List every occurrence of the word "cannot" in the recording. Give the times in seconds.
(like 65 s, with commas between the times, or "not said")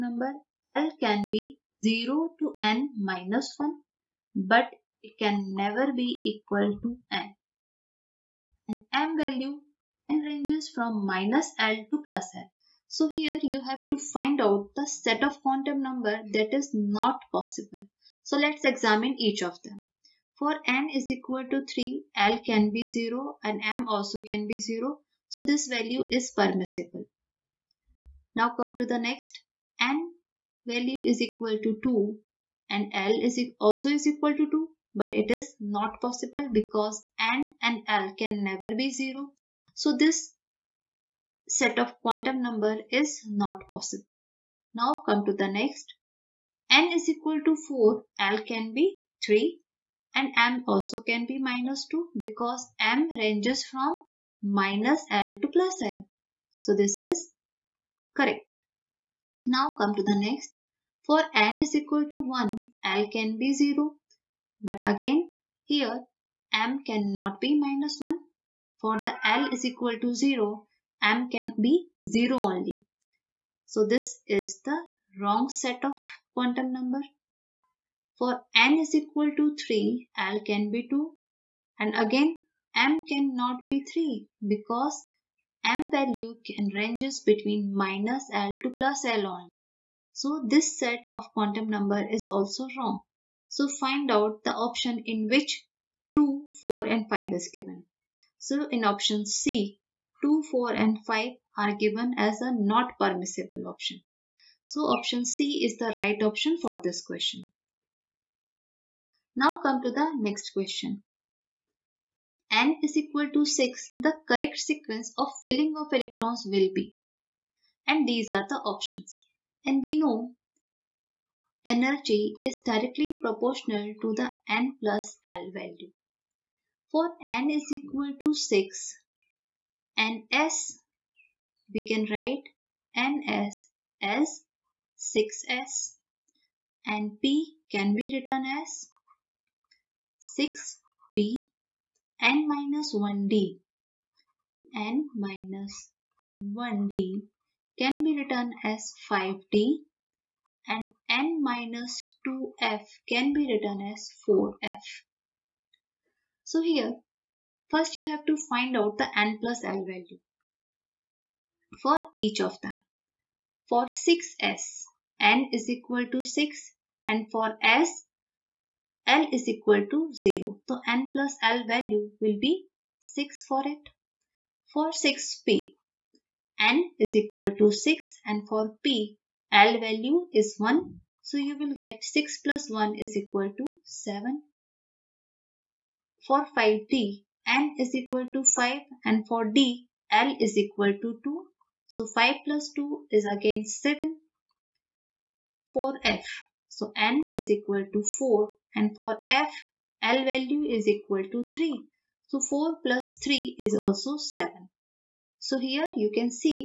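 66 s, 83 s.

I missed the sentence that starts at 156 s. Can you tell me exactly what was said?
So here first you have to find out the n plus l value for each of them.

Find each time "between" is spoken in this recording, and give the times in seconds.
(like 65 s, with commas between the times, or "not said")
87 s.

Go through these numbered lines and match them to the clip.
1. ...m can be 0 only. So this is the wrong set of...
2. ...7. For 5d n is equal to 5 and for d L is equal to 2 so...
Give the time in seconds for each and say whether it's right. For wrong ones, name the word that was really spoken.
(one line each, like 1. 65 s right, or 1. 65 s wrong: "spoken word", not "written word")
1. 71 s right
2. 183 s right.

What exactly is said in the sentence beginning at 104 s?
So option C is the right option for this question.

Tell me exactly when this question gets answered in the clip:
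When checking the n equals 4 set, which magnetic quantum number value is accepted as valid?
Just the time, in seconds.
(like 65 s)
51 s.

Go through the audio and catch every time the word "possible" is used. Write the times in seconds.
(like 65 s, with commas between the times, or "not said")
17 s, 35 s, 43 s.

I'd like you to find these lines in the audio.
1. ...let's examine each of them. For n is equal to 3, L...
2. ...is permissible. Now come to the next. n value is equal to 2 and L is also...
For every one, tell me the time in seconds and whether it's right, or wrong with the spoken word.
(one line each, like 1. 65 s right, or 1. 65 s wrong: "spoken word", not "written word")
1. 18 s right
2. 26 s right.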